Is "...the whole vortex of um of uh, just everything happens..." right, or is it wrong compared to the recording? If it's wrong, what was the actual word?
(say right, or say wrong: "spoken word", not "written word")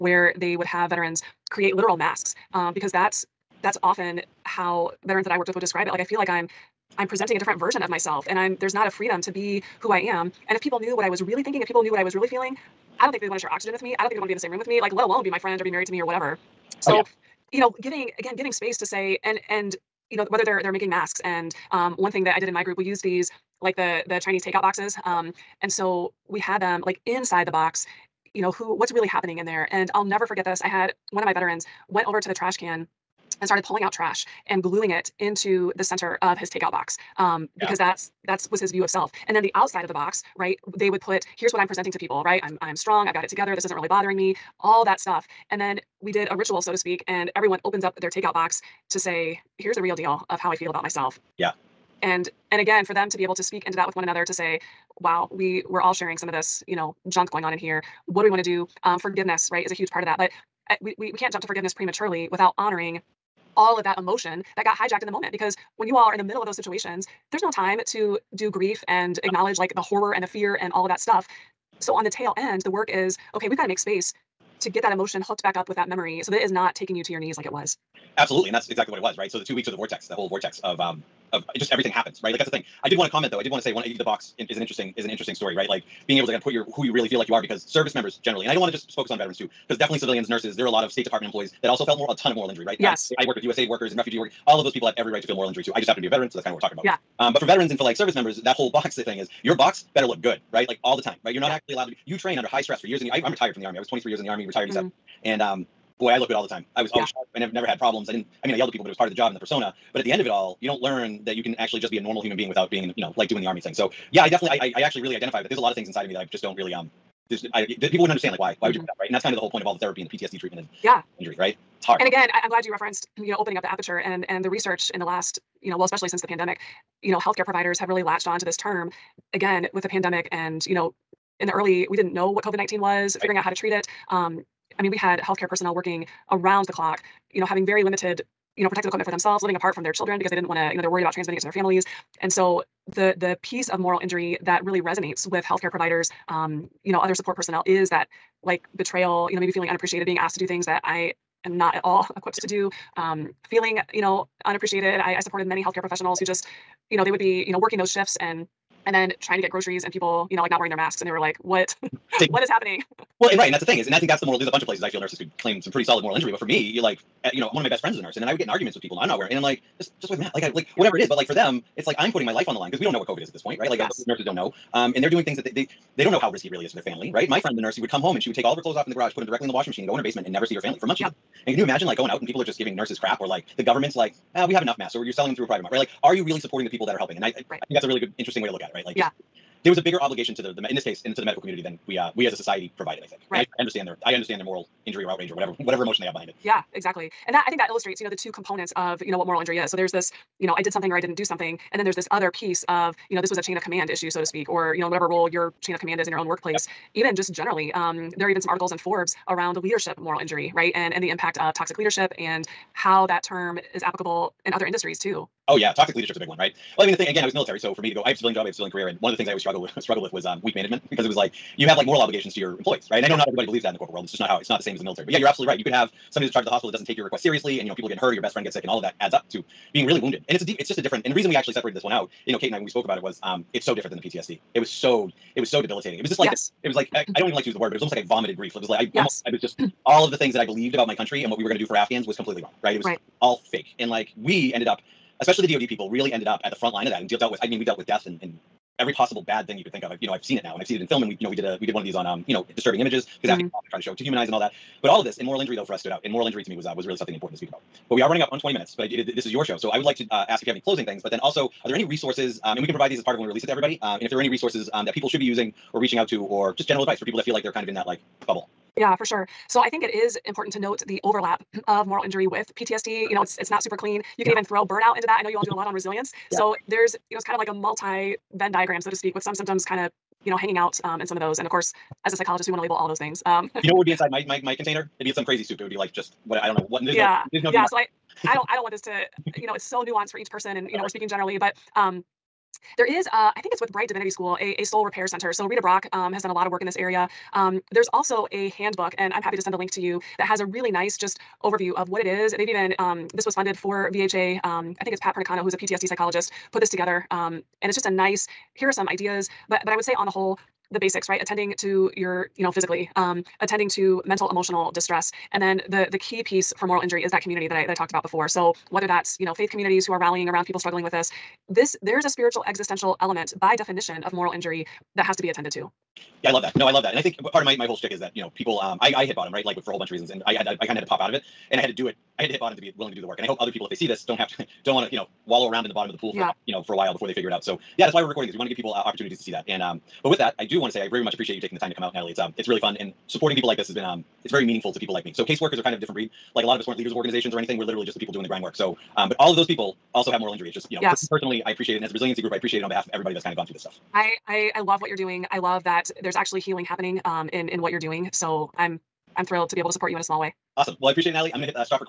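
right.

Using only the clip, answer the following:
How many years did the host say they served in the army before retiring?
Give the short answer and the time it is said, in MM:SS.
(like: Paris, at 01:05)
23, at 01:43.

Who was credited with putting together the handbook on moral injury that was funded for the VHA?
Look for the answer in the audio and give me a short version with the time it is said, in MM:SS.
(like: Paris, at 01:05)
Pat Pernicano, at 05:04.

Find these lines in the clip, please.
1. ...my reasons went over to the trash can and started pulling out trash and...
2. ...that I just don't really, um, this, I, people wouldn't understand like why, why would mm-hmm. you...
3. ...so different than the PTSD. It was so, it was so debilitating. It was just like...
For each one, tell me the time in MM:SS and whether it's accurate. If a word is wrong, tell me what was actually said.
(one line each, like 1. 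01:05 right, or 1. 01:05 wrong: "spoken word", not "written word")
1. 00:31 wrong: "veterans", not "reasons"
2. 01:56 right
3. 03:53 right.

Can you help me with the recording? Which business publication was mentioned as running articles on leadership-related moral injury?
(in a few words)
Forbes.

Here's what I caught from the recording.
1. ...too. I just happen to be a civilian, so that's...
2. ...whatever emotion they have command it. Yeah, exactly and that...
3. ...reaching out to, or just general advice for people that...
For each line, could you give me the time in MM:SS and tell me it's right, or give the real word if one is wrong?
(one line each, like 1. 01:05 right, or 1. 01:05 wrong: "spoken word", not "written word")
1. 01:35 wrong: "veteran", not "civilian"
2. 03:15 wrong: "behind", not "command"
3. 04:25 right.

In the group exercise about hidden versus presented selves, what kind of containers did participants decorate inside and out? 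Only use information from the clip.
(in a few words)
Chinese takeout boxes.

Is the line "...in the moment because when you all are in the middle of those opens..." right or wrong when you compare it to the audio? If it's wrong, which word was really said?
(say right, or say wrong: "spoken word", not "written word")
wrong: "situations", not "opens".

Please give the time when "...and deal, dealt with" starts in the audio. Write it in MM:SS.
04:07.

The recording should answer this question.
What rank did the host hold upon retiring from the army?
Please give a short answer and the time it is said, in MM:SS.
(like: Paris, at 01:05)
E7, at 01:44.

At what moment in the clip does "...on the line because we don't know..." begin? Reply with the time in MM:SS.
02:52.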